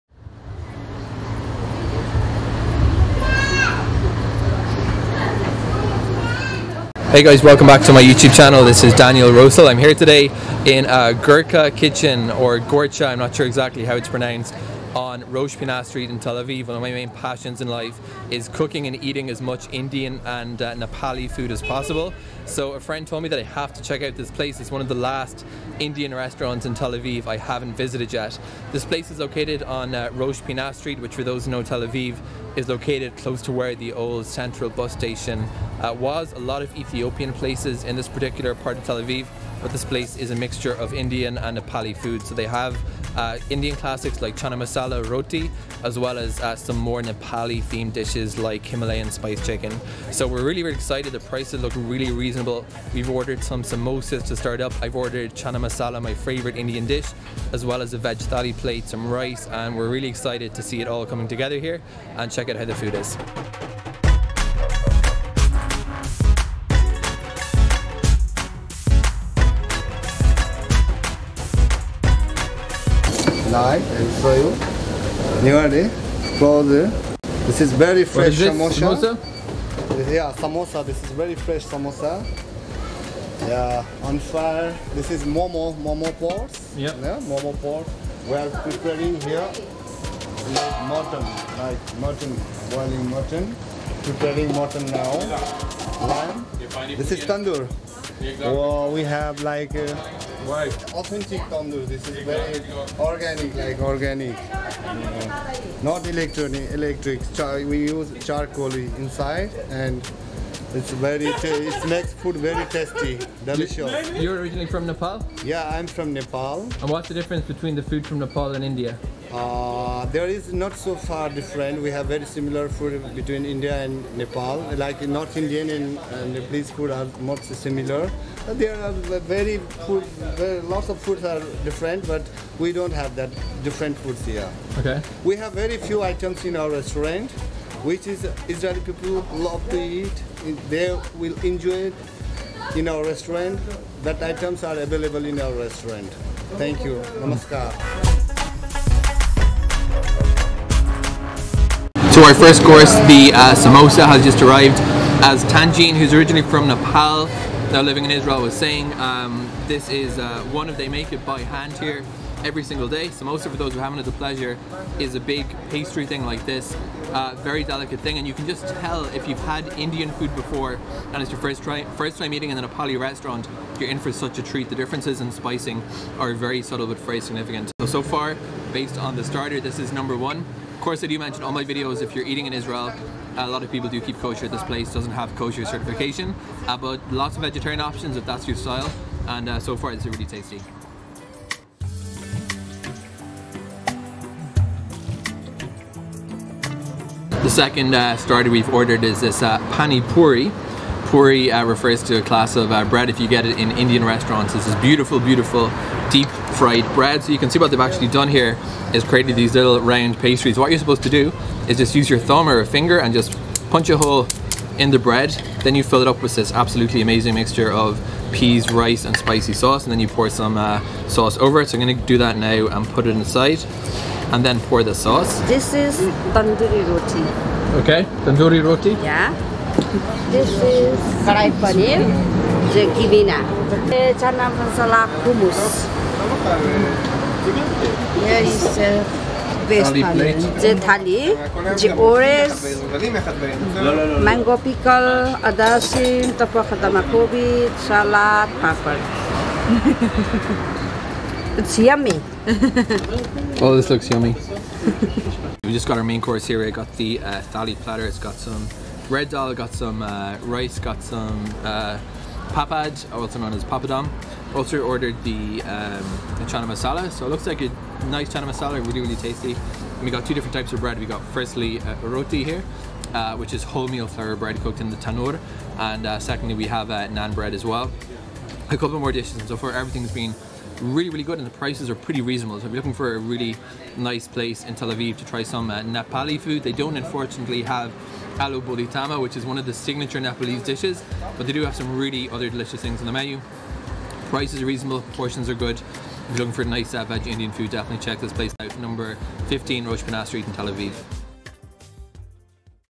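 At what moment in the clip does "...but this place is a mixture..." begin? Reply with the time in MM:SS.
00:39.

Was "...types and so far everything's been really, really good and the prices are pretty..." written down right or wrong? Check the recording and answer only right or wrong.
wrong.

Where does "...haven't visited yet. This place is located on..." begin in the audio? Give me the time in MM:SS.
00:27.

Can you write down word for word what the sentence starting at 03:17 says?
second uh, starter we've ordered is this uh, pani puri.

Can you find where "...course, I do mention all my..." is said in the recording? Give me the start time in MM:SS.
03:00.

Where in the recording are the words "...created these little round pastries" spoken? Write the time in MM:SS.
03:29.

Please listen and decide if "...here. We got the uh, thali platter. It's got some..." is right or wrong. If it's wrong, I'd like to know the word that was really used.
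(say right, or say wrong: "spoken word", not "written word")
right.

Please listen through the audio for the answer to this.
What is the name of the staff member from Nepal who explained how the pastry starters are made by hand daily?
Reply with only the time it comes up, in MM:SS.
02:35.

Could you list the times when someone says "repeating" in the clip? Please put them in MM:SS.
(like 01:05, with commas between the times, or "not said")
not said.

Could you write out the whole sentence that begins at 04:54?
Prices are reasonable, portions are good.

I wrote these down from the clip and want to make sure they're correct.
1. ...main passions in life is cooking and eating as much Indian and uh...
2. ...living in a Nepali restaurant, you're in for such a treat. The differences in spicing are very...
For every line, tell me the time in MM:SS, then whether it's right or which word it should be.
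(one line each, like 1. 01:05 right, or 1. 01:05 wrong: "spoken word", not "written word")
1. 00:16 right
2. 02:52 wrong: "eating", not "living".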